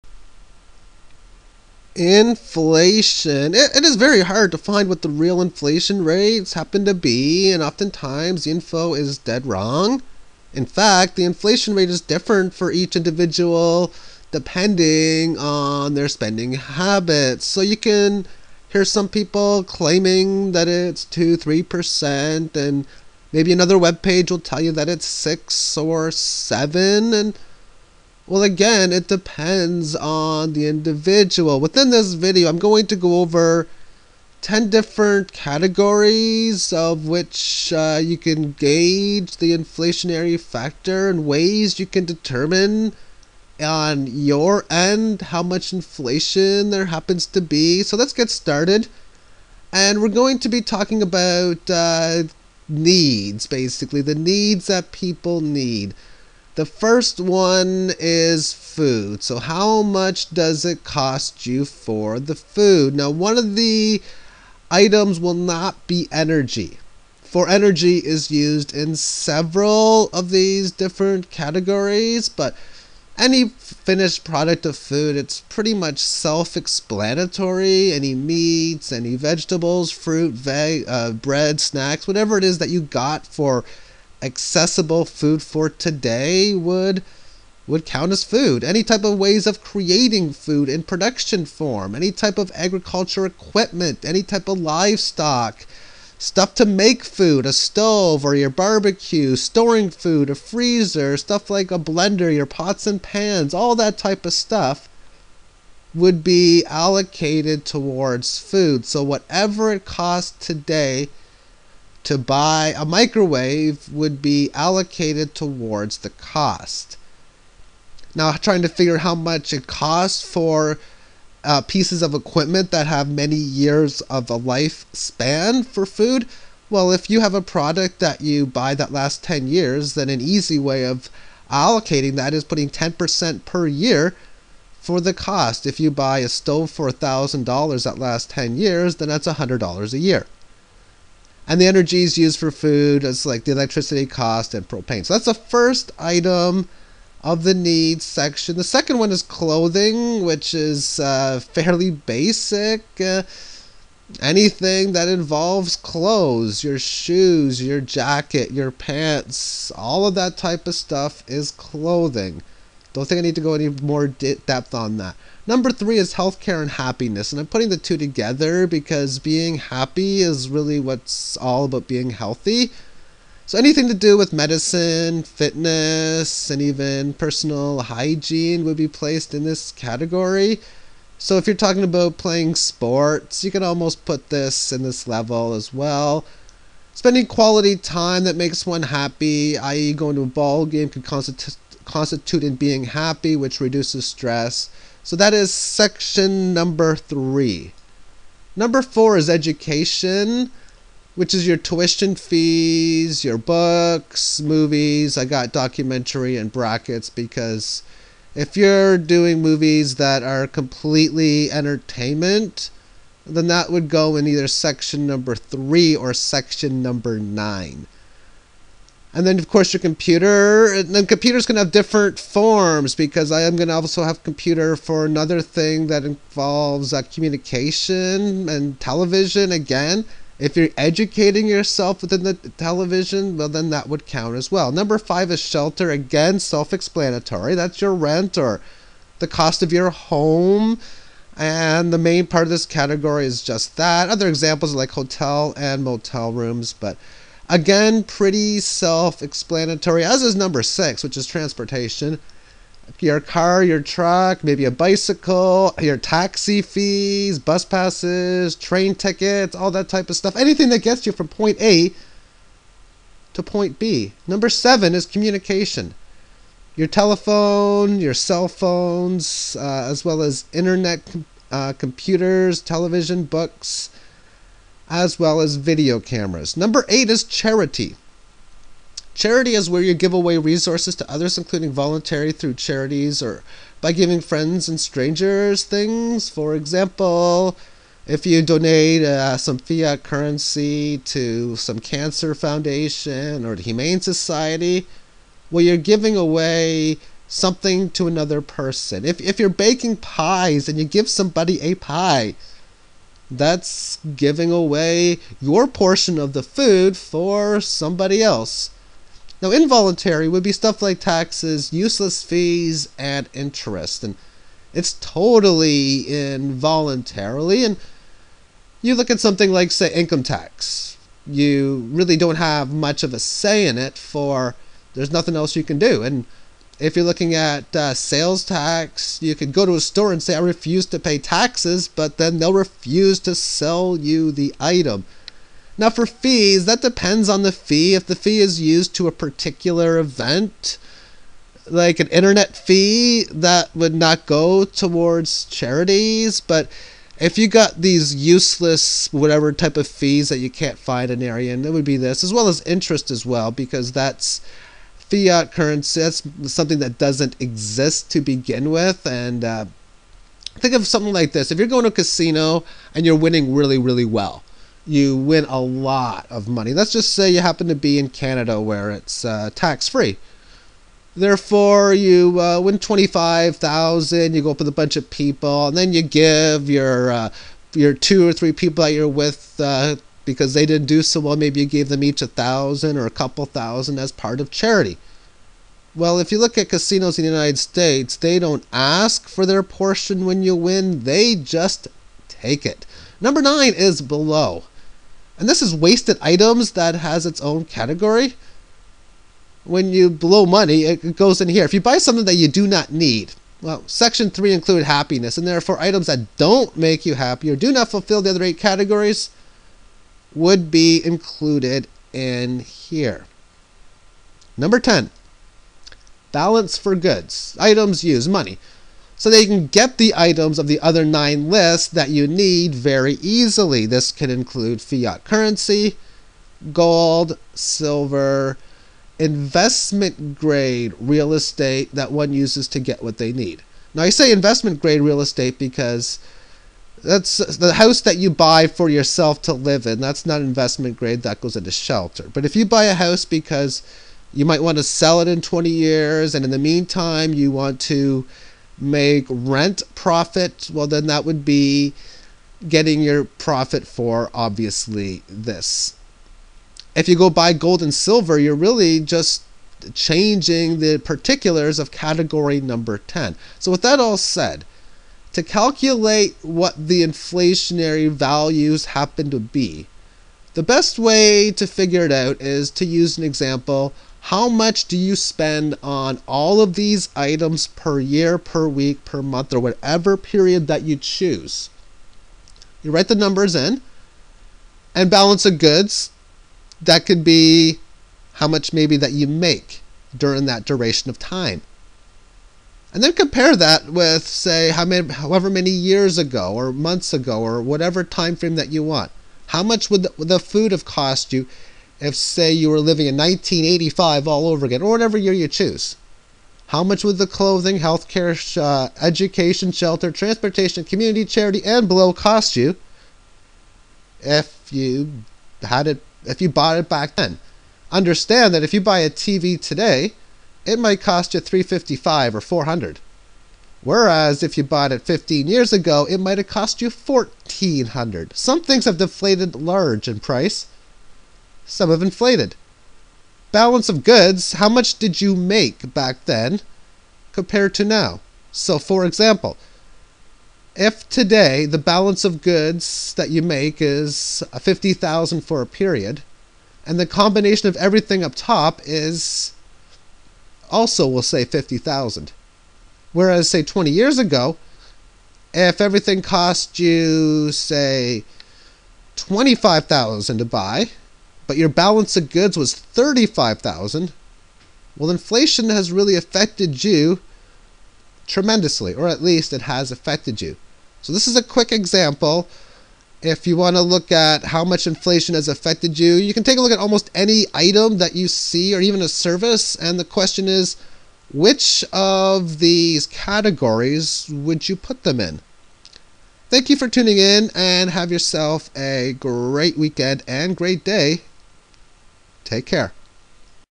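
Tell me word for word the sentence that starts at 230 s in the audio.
If you're educating yourself within the television, well, then that would count as well.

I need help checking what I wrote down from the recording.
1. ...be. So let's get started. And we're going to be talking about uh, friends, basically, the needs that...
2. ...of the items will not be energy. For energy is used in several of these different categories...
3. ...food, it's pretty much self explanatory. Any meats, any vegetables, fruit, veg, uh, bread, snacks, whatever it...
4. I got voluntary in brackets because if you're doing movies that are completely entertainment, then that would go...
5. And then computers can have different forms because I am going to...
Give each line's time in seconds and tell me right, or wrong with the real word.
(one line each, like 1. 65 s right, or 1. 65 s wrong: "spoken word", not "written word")
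1. 47 s wrong: "needs", not "friends"
2. 63 s right
3. 74 s right
4. 205 s wrong: "documentary", not "voluntary"
5. 220 s right.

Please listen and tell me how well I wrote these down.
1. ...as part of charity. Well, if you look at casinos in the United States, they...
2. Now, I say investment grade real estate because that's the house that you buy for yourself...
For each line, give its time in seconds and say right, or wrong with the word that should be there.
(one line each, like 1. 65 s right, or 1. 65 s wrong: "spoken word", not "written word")
1. 383 s right
2. 433 s right.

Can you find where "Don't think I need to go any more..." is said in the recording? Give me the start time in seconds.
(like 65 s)
162 s.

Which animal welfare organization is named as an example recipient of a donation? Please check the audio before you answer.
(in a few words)
The Humane Society.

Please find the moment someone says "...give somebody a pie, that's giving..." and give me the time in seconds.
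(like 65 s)
300 s.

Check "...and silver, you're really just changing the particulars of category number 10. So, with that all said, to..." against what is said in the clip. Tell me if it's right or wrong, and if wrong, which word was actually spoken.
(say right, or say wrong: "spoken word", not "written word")
right.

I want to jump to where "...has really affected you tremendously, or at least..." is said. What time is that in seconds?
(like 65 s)
565 s.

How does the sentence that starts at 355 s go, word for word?
That's something that doesn't exist to begin with.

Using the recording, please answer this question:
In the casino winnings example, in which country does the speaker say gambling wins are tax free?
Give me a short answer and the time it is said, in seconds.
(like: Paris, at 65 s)
Canada, at 368 s.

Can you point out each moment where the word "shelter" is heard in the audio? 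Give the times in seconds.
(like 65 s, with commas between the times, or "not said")
235 s, 441 s, 509 s.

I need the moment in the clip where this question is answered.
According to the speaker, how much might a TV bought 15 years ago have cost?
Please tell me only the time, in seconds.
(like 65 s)
526 s.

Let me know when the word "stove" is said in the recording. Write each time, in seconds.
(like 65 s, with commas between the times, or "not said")
97 s, 136 s.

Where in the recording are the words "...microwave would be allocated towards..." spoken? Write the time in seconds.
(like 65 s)
112 s.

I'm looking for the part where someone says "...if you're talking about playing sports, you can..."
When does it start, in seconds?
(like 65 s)
181 s.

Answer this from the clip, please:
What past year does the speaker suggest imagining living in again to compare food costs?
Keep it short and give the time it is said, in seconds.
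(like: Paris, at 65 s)
1985, at 503 s.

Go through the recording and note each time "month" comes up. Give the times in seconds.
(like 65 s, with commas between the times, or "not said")
479 s, 496 s.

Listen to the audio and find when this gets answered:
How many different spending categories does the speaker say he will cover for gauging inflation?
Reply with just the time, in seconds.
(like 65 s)
34 s.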